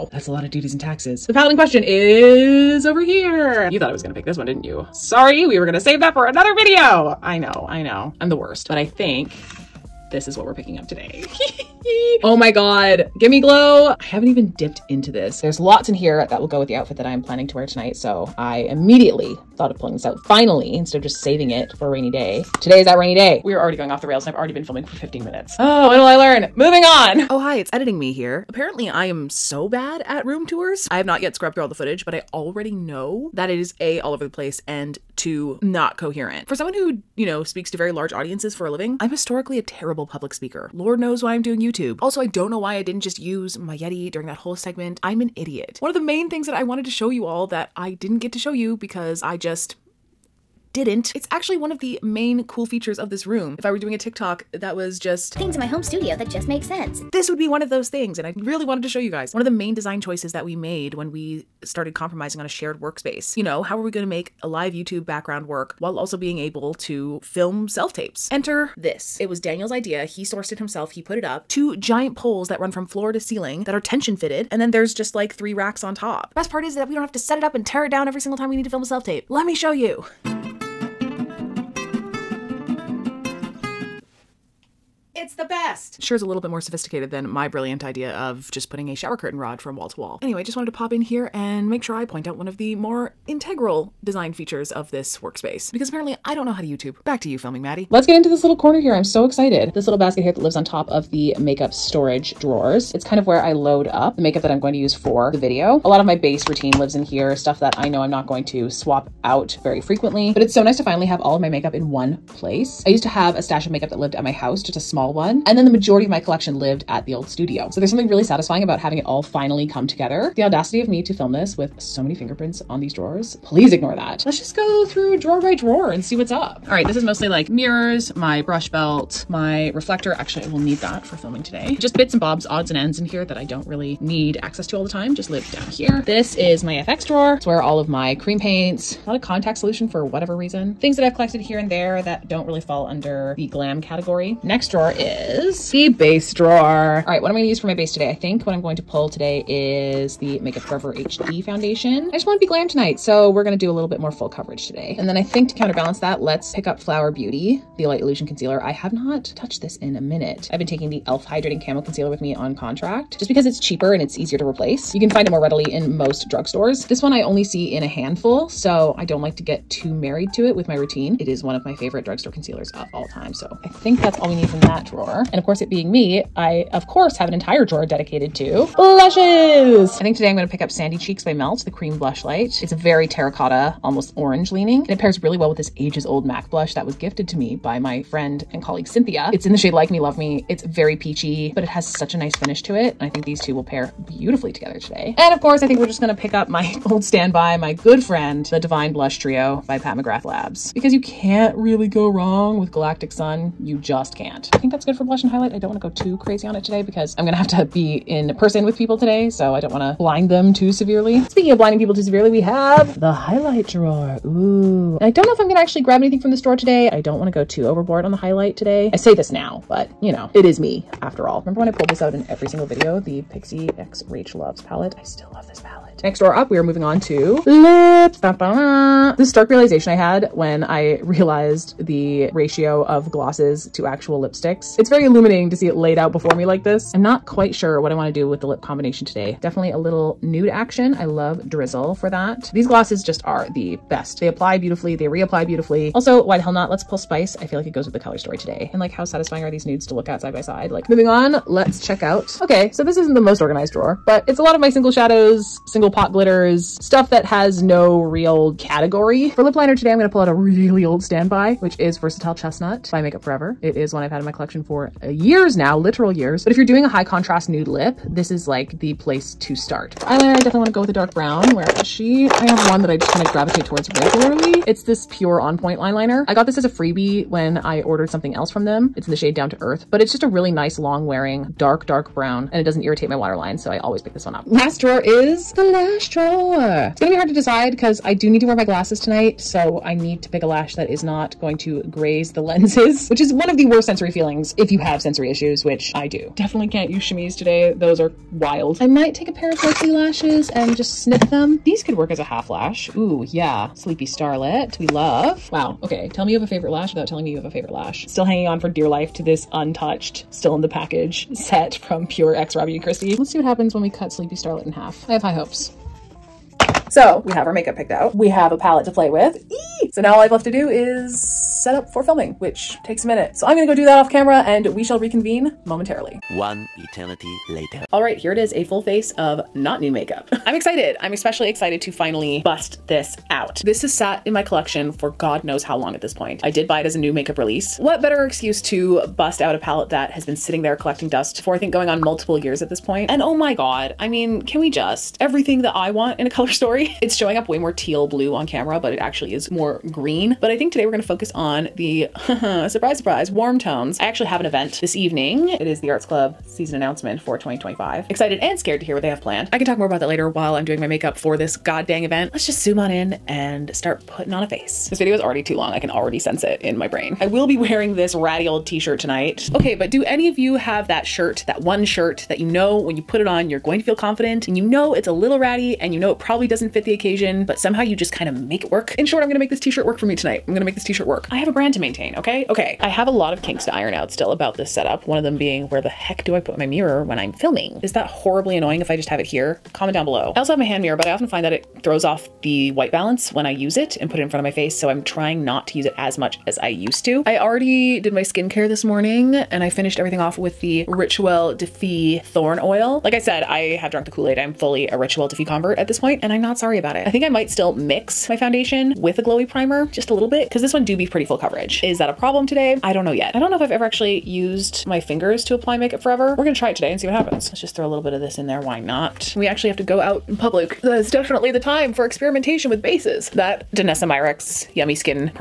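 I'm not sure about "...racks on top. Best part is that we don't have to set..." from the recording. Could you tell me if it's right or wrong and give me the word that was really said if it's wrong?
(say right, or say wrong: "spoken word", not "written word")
right.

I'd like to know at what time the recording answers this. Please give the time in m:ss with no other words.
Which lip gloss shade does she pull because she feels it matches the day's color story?
4:06.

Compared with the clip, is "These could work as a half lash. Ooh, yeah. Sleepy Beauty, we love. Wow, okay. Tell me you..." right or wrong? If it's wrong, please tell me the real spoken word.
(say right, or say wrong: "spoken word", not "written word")
wrong: "Starlet", not "Beauty".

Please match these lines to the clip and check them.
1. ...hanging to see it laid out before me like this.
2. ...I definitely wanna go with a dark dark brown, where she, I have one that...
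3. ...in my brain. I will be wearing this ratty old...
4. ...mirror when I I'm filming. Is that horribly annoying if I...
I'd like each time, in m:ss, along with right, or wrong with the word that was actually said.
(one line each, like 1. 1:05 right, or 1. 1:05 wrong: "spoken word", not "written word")
1. 3:55 wrong: "illuminating", not "hanging"
2. 4:30 right
3. 6:06 right
4. 6:26 right.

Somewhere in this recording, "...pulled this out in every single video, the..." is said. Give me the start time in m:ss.
3:41.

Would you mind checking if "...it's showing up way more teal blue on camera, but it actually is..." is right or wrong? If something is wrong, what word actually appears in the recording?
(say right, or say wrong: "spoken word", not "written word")
right.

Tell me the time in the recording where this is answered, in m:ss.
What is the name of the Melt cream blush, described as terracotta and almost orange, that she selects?
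3:00.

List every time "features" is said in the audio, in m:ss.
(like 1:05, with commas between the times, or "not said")
0:52, 1:34.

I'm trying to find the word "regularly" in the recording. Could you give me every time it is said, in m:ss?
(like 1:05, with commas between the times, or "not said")
4:33.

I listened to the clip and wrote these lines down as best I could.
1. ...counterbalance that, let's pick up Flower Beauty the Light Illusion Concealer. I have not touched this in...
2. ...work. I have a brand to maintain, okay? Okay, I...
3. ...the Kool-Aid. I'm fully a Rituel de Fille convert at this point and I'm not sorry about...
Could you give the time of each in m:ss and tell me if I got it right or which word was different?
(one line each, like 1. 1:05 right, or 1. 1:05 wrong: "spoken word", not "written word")
1. 2:35 right
2. 6:21 right
3. 6:44 right.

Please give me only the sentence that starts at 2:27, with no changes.
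All right, what am I gonna use for my base today?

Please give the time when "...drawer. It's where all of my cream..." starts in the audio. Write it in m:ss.
2:17.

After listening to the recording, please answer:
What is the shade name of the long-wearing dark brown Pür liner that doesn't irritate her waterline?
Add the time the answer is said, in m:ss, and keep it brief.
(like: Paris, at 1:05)
Down to Earth, at 4:39.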